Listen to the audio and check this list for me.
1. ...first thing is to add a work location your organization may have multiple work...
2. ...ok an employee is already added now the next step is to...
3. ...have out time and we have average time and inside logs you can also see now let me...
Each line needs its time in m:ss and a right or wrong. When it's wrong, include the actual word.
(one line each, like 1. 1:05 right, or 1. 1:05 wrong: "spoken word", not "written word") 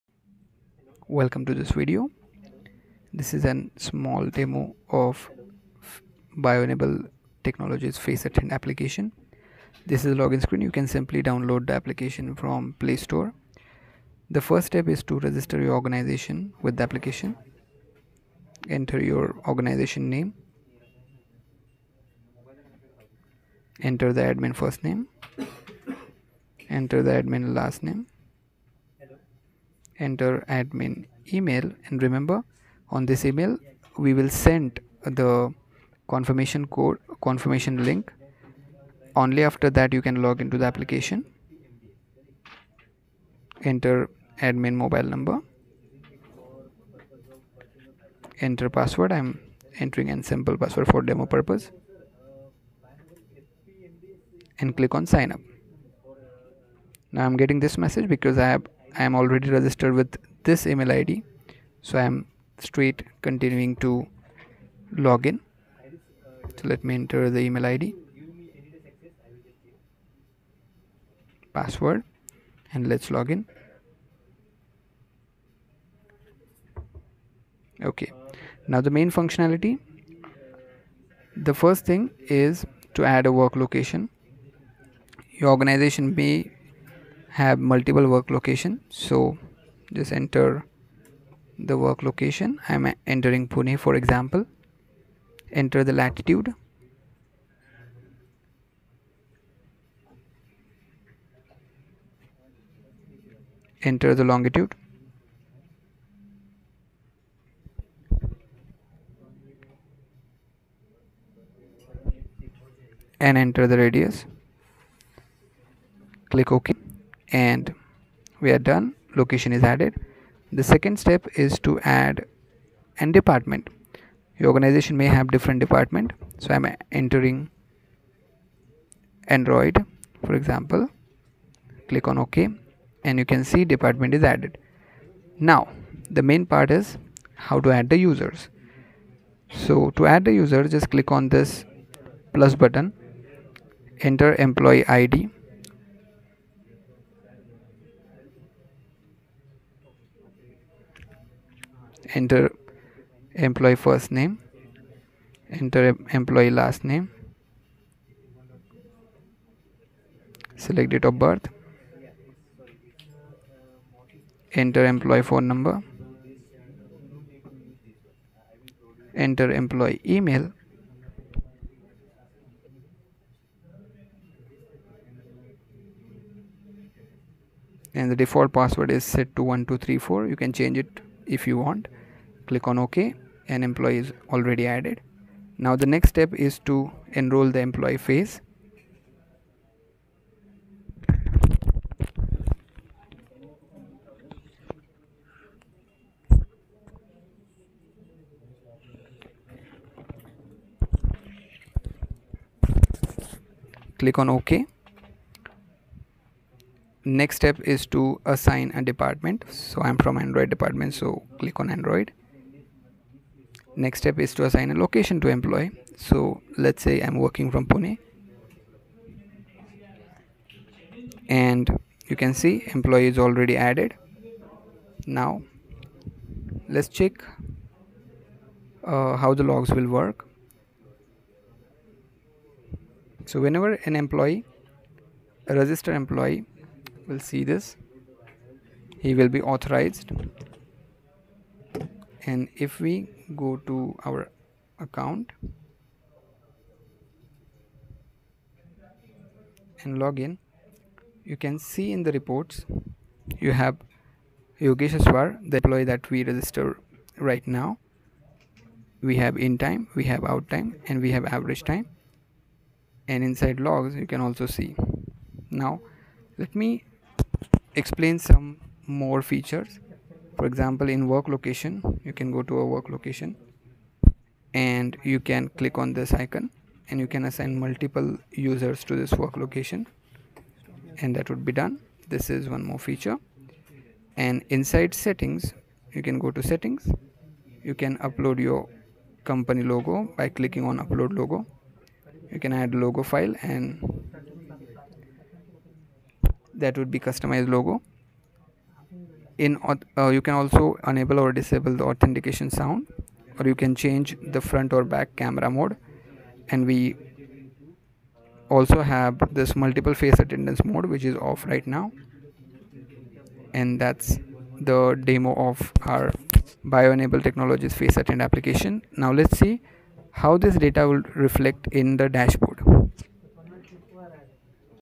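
1. 1:21 right
2. 3:02 right
3. 4:20 right.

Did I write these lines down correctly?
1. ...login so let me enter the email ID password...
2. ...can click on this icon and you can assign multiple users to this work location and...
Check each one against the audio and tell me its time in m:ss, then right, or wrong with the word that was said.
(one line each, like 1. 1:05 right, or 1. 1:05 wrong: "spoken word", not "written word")
1. 1:04 right
2. 4:35 right.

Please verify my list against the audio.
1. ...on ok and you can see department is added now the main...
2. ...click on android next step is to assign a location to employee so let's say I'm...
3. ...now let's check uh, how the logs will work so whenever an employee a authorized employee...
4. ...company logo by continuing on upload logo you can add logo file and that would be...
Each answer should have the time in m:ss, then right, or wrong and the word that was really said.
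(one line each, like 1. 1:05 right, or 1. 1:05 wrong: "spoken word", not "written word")
1. 2:12 right
2. 3:31 right
3. 3:45 wrong: "registered", not "authorized"
4. 4:49 wrong: "clicking", not "continuing".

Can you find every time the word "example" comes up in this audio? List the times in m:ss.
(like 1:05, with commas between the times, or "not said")
1:33, 2:10, 4:30.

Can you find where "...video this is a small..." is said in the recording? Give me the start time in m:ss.
0:01.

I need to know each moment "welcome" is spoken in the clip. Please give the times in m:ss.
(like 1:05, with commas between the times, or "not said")
0:01.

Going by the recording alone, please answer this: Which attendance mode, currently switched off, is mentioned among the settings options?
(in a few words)
Multiple face attendance mode.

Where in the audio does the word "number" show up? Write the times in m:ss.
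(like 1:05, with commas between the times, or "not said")
0:45, 2:45.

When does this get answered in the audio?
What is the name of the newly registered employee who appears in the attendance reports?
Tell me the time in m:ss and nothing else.
4:14.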